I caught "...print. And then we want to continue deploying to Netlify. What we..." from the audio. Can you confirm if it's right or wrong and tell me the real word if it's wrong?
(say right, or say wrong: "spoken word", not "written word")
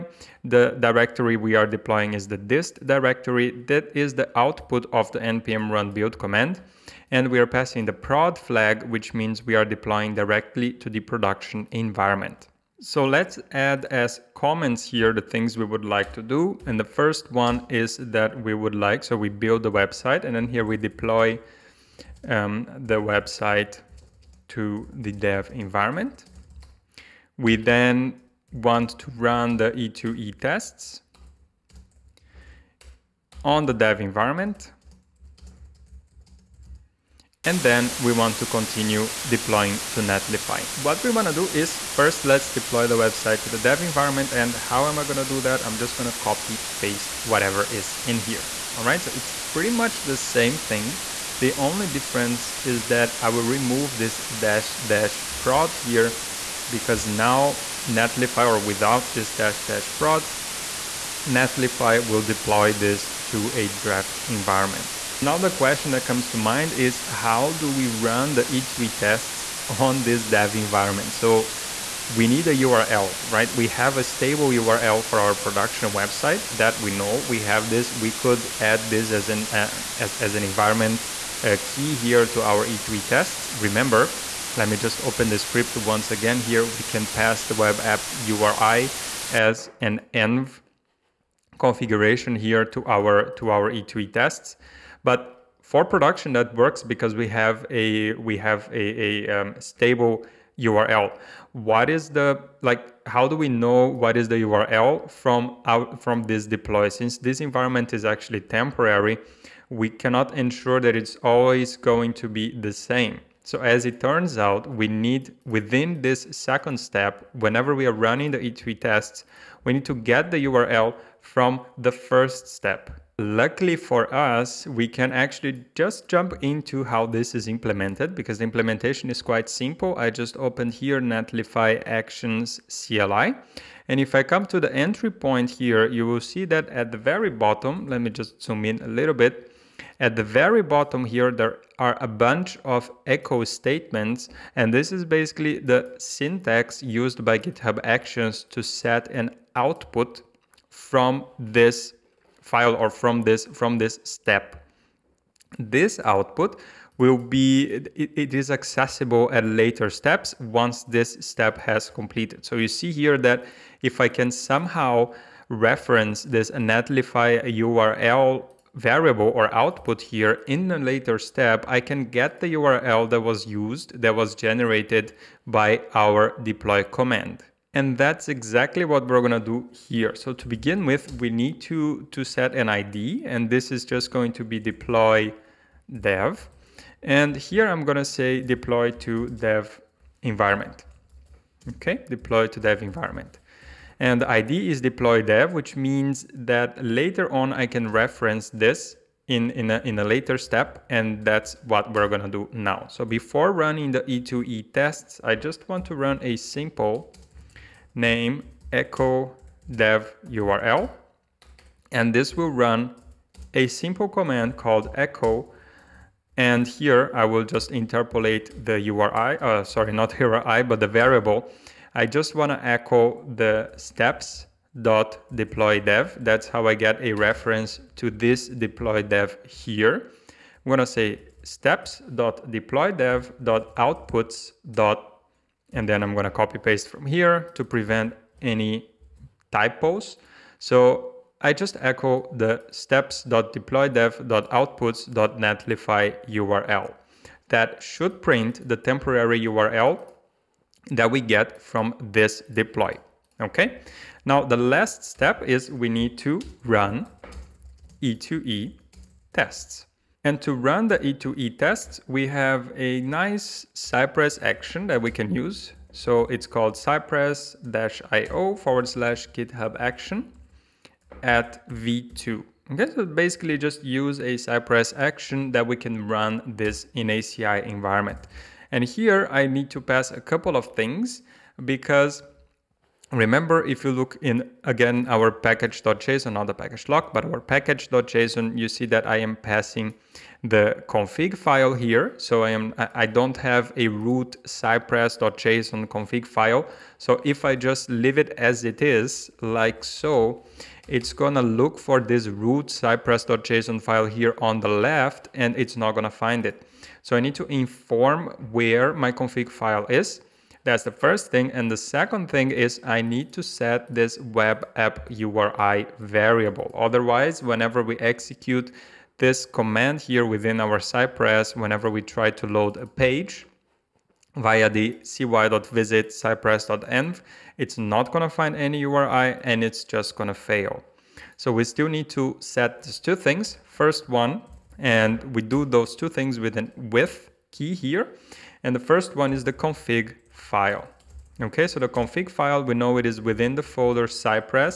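wrong: "environment", not "print".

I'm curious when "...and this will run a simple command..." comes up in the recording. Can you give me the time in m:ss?
3:31.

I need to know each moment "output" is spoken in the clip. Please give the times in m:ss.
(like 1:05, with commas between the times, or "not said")
0:04, 2:29, 2:36, 2:49, 3:53, 4:04.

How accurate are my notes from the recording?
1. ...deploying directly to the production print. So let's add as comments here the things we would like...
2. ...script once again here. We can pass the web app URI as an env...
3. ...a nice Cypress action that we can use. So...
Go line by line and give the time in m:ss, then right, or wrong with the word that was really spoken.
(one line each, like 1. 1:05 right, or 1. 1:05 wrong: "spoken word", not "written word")
1. 0:09 wrong: "environment", not "print"
2. 1:25 right
3. 4:22 right.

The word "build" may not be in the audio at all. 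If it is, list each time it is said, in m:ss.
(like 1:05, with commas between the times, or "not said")
0:05, 0:19.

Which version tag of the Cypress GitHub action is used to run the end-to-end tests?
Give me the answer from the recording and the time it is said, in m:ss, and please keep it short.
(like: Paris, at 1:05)
v2, at 4:31.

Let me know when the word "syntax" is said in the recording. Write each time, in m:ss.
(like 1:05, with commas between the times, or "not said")
2:25.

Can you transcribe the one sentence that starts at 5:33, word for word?
First one, and we do those two things with an with key here.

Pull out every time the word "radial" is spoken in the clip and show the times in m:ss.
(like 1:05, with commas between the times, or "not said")
not said.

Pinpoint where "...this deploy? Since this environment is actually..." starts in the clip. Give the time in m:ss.
1:46.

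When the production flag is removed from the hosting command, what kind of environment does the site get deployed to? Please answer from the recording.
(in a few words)
A draft environment.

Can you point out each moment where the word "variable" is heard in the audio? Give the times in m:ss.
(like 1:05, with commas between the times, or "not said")
2:48, 3:40, 5:15.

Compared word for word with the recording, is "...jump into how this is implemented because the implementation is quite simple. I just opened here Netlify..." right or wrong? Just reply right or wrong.
right.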